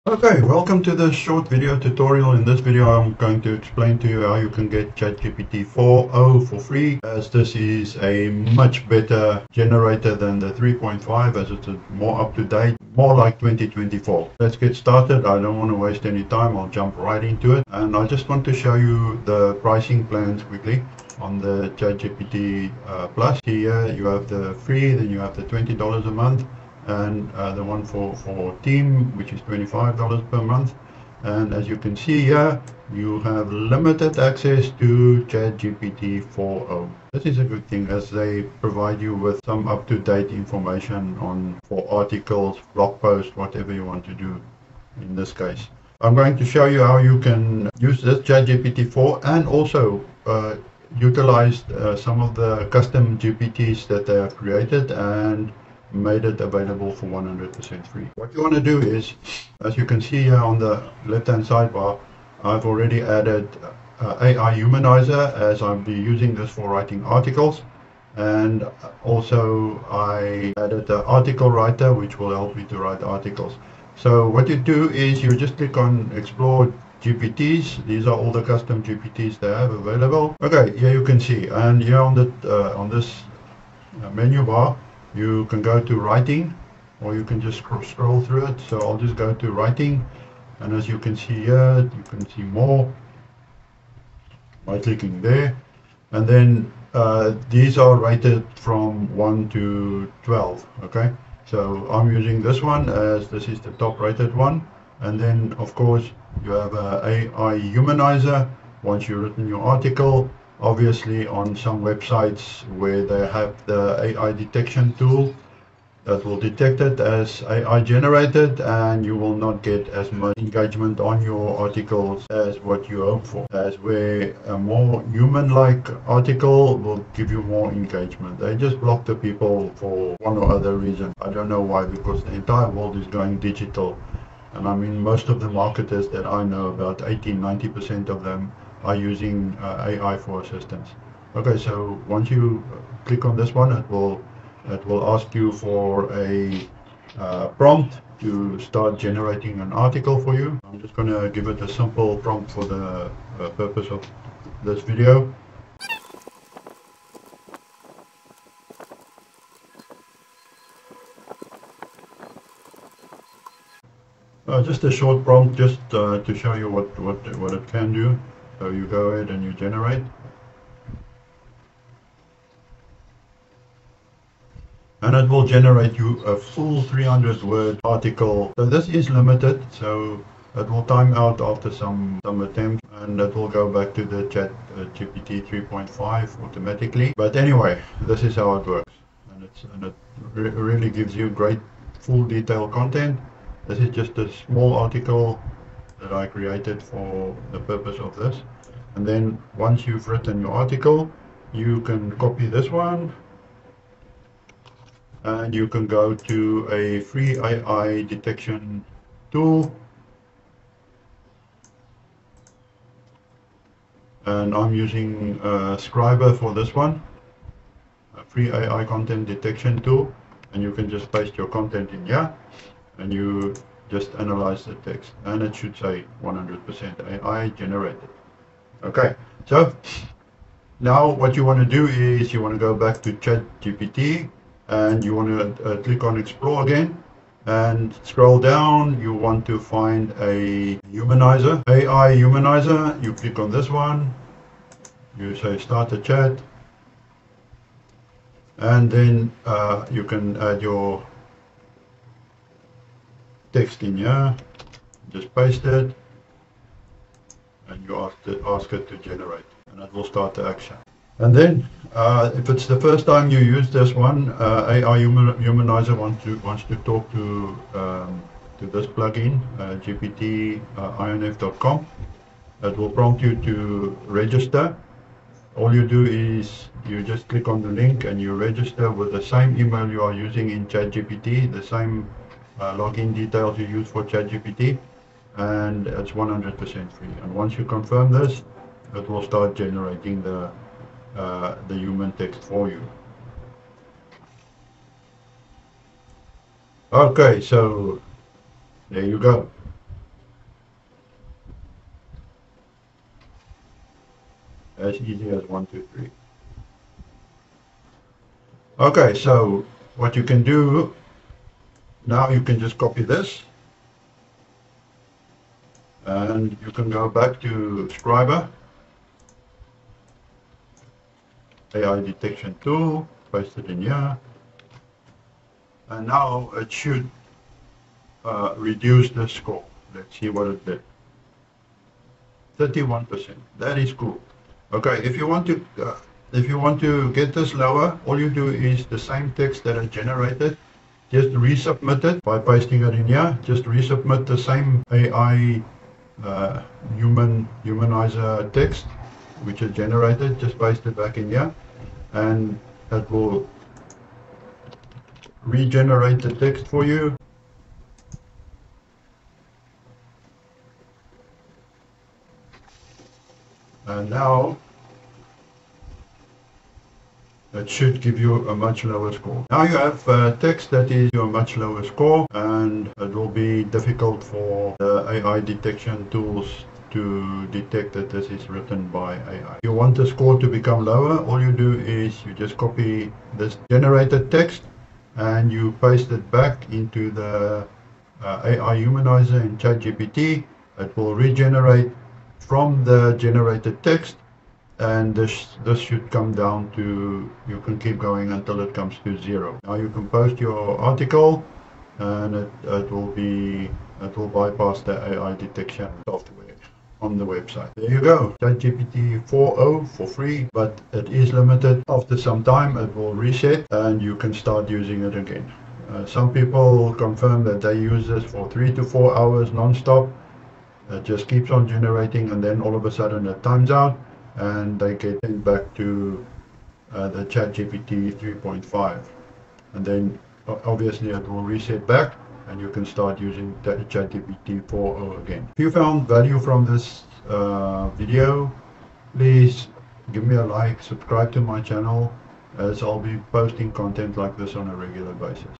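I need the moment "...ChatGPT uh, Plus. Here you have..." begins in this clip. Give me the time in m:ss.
0:21.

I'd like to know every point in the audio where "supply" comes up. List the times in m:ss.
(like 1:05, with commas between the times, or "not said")
not said.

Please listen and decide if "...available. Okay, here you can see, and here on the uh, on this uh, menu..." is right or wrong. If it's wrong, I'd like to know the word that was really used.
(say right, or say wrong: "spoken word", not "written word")
right.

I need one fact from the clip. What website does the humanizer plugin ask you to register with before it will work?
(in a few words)
GPT-INF.com.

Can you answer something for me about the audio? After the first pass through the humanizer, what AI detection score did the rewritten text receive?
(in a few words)
31%.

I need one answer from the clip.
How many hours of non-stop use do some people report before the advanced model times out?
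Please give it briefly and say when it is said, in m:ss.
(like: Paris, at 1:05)
3 to 4 hours, at 6:58.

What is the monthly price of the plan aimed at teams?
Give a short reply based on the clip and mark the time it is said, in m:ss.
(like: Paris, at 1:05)
$25, at 0:29.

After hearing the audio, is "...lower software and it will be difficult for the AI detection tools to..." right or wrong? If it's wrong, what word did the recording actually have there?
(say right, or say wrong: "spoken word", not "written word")
wrong: "score", not "software".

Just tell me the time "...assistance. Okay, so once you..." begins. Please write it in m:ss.
2:20.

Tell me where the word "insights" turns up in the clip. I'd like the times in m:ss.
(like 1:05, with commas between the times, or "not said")
not said.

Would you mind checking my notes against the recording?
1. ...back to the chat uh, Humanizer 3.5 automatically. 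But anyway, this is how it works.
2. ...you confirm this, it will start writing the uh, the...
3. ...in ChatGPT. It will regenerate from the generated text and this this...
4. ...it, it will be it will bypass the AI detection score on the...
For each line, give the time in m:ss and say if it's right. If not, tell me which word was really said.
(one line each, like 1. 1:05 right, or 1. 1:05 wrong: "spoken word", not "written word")
1. 3:03 wrong: "GPT", not "Humanizer"
2. 4:47 wrong: "generating", not "writing"
3. 6:29 right
4. 6:42 wrong: "software", not "score".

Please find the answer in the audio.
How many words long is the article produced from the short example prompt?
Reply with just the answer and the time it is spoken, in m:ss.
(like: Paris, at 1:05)
300, at 2:56.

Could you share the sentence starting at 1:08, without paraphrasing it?
And also I added the article writer, which will help me to write articles.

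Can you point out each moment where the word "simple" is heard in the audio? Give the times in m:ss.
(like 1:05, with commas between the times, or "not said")
2:31.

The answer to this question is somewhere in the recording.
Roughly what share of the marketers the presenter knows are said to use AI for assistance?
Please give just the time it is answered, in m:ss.
2:17.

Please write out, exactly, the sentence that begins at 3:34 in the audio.
And I'm using uh, Scribbr for this one, a free AI content detection tool.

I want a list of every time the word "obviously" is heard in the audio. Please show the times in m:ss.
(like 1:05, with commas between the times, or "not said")
1:50, 7:10.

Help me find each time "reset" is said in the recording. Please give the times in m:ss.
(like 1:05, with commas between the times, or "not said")
6:53, 7:11.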